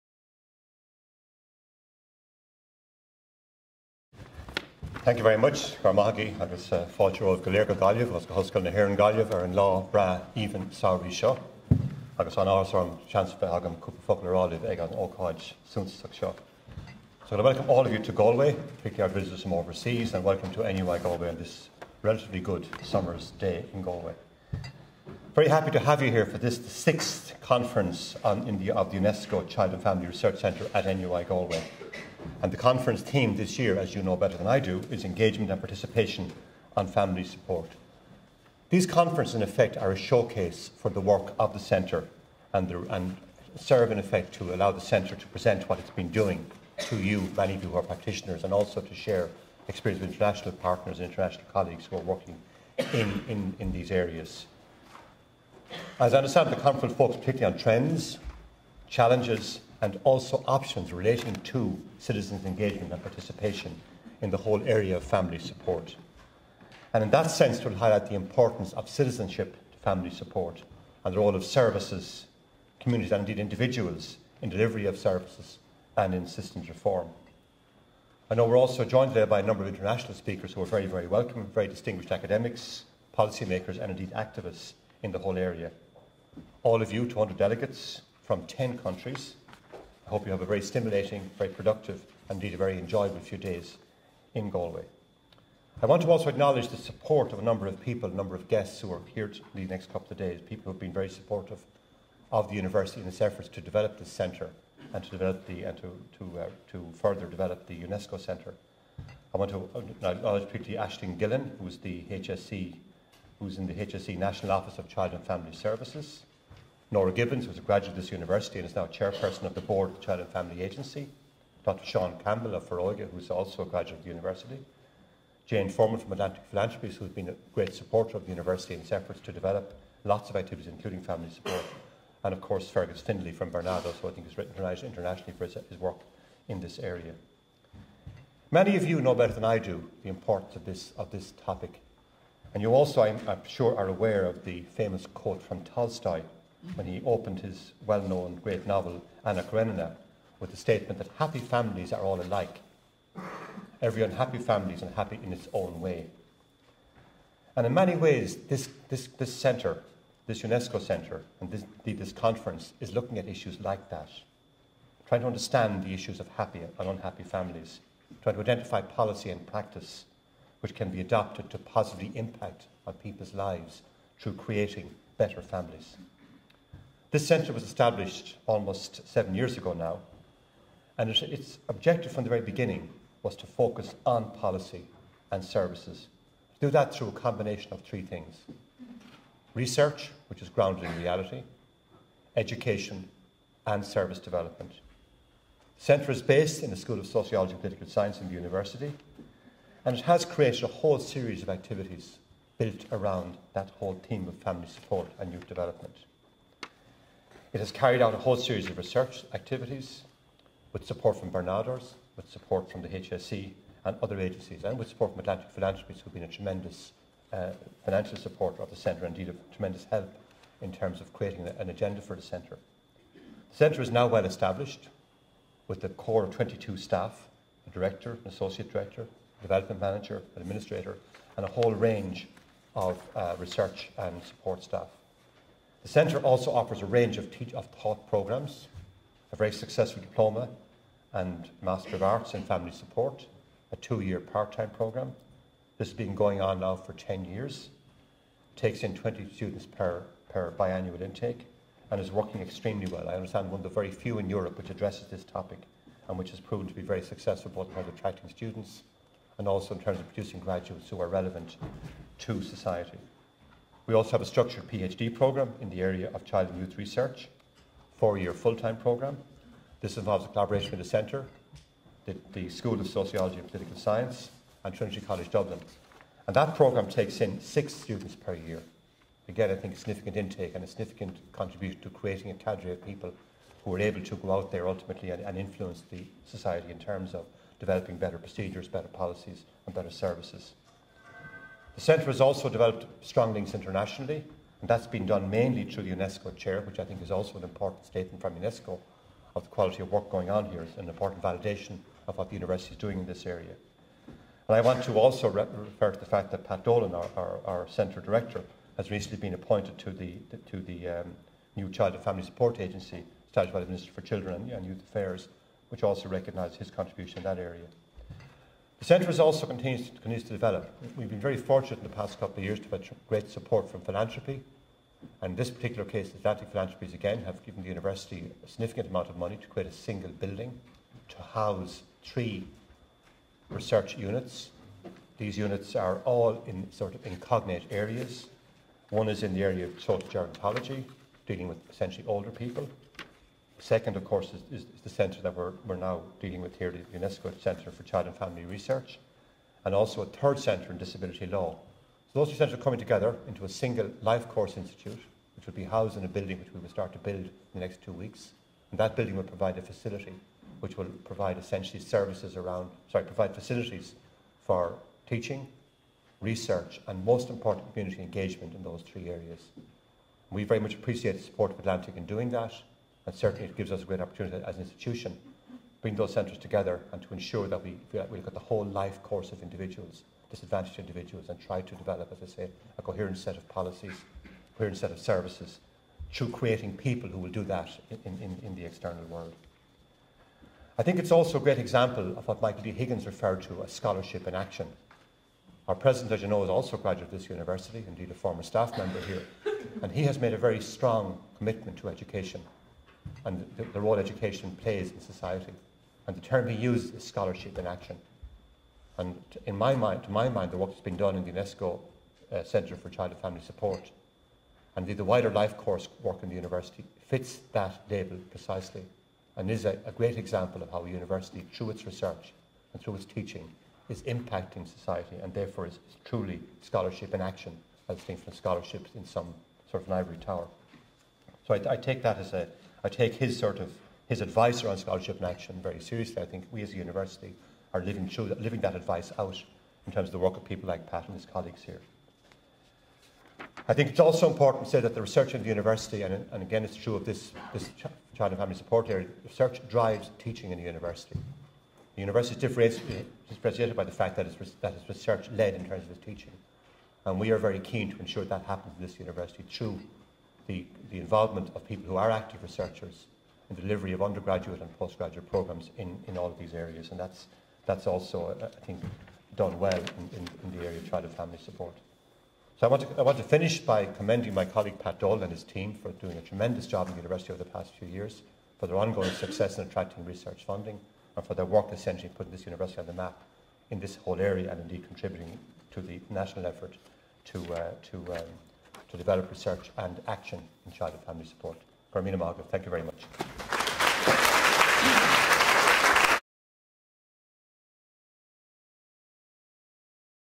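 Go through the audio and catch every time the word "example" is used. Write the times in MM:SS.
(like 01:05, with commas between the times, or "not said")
06:31, 07:00.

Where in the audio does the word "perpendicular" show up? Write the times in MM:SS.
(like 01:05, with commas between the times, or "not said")
not said.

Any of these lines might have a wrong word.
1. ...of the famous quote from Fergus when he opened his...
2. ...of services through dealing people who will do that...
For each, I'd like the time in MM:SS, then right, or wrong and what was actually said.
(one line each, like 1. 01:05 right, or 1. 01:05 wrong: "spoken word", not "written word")
1. 02:24 wrong: "Tolstoy", not "Fergus"
2. 06:24 wrong: "creating", not "dealing".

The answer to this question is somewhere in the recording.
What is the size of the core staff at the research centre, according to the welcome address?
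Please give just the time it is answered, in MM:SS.
03:46.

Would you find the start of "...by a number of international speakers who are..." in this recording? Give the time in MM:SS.
01:19.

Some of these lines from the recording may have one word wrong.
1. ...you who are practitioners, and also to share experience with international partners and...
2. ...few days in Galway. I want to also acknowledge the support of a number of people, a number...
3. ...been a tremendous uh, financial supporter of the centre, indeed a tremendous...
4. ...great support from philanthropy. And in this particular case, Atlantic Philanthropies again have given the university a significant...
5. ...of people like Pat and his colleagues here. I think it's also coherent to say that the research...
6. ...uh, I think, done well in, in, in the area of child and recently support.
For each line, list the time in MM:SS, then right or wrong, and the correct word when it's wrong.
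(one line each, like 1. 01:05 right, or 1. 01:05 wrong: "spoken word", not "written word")
1. 00:47 right
2. 01:33 right
3. 03:36 right
4. 05:23 right
5. 07:20 wrong: "important", not "coherent"
6. 07:48 wrong: "family", not "recently".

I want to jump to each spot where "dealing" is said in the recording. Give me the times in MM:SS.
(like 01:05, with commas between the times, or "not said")
05:41, 05:46.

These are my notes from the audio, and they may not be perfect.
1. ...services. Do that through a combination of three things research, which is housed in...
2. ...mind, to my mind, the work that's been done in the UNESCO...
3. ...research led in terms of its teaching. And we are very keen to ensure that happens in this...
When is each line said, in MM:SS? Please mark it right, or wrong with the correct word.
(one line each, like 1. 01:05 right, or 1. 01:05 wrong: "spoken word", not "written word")
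1. 03:05 wrong: "grounded", not "housed"
2. 06:49 right
3. 07:34 right.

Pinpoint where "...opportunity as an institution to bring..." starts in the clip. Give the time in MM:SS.
06:13.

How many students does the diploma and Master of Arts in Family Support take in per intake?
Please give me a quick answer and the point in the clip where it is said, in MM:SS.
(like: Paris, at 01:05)
20, at 04:08.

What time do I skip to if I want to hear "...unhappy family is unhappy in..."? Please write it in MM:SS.
02:34.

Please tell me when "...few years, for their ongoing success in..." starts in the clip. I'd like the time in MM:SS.
07:57.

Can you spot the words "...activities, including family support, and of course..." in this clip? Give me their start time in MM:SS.
02:10.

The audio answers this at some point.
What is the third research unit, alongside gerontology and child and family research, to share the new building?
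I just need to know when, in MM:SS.
05:50.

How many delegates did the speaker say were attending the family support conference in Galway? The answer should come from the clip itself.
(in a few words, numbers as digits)
200.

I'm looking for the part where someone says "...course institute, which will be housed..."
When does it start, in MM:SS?
05:54.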